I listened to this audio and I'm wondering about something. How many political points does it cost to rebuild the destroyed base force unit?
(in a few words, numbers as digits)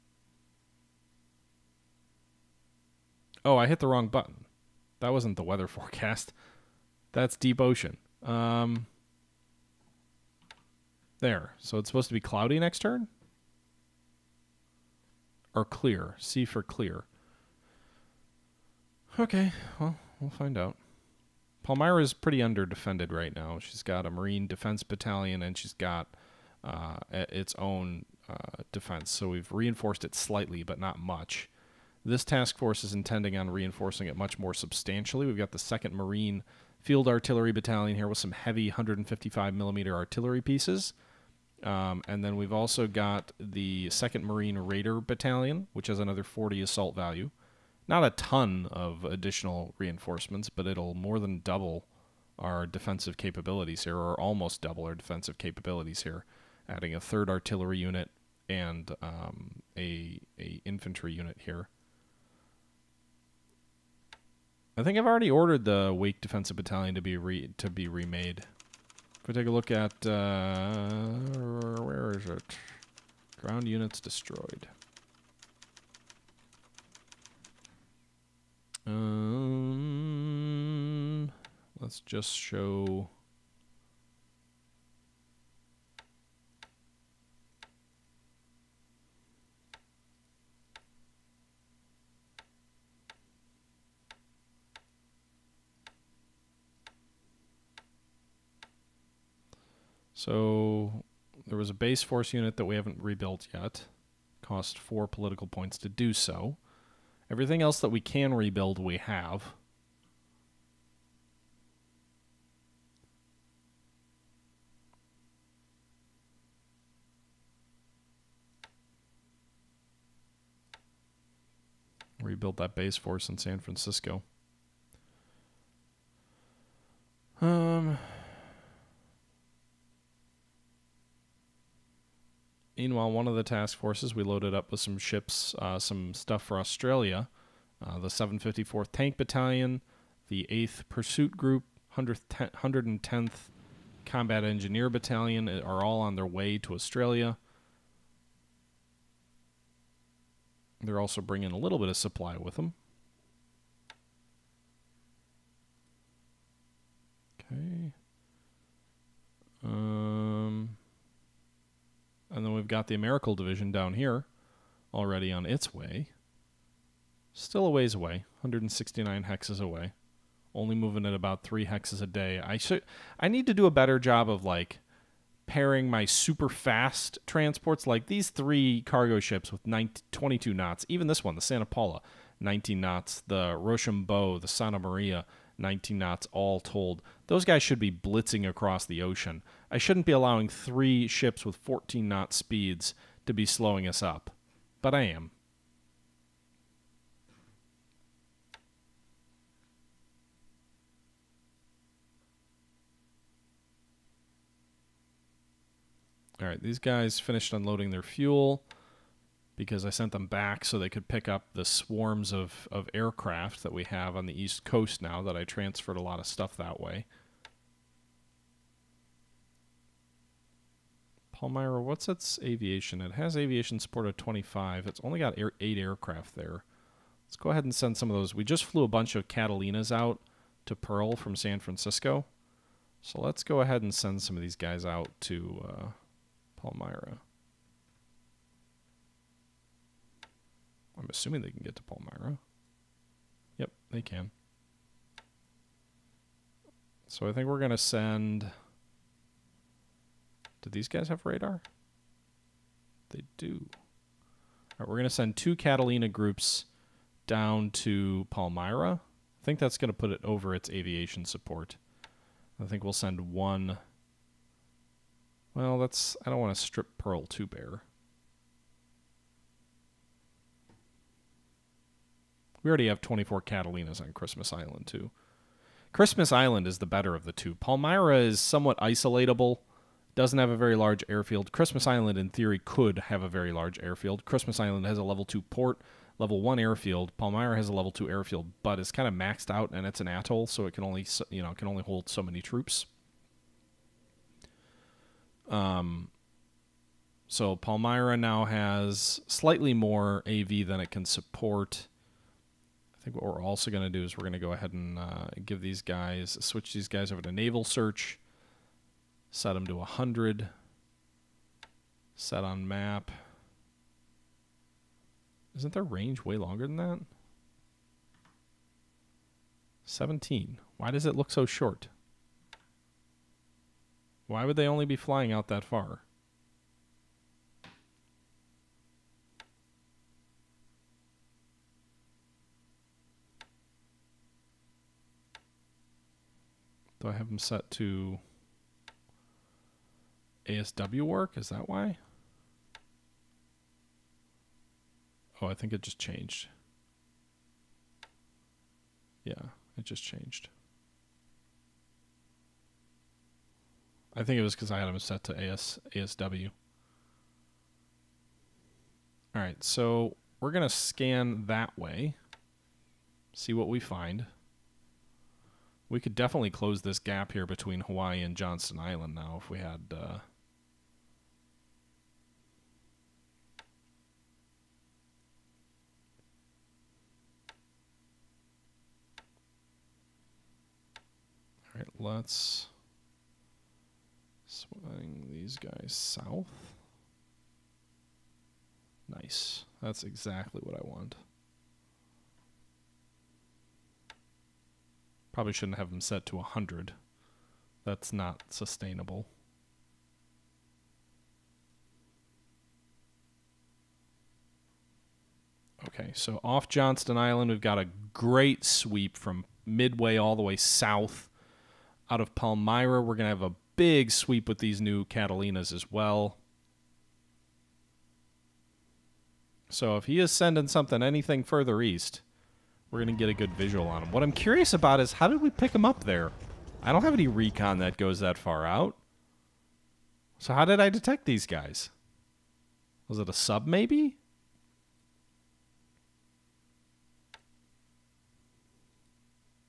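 4.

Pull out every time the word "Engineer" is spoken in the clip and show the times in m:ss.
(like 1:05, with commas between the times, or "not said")
2:24.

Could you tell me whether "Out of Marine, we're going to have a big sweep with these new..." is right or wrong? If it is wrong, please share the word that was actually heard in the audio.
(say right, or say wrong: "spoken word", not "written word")
wrong: "Palmyra", not "Marine".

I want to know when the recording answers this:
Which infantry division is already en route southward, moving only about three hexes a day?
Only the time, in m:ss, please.
2:42.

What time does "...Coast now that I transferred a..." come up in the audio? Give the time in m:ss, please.
3:34.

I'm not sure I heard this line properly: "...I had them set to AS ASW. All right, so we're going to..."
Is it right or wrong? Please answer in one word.
right.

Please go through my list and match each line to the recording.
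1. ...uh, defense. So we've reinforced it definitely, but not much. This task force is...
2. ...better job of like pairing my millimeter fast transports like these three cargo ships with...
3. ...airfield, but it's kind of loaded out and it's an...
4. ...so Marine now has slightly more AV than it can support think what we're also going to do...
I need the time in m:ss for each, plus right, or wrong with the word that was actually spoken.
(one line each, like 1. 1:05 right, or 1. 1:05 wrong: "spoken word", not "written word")
1. 0:28 wrong: "slightly", not "definitely"
2. 2:53 wrong: "super", not "millimeter"
3. 4:48 wrong: "maxed", not "loaded"
4. 4:57 wrong: "Palmyra", not "Marine".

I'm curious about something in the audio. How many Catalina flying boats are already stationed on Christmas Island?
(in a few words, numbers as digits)
24.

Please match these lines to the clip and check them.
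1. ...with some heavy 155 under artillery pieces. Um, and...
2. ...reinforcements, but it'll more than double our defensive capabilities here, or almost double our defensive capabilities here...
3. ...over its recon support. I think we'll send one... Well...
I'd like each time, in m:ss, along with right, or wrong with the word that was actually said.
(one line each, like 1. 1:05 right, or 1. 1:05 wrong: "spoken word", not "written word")
1. 0:38 wrong: "millimeter", not "under"
2. 0:49 right
3. 4:20 wrong: "aviation", not "recon".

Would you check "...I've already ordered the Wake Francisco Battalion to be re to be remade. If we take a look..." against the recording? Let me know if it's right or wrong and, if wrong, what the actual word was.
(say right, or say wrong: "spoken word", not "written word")
wrong: "Defensive", not "Francisco".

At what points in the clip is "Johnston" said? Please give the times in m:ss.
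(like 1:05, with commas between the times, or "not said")
6:08, 6:46.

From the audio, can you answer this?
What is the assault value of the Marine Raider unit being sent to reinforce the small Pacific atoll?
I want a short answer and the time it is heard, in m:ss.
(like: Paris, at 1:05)
40, at 0:46.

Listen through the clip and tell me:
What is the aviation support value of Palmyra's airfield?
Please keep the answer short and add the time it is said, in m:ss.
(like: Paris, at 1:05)
25, at 3:44.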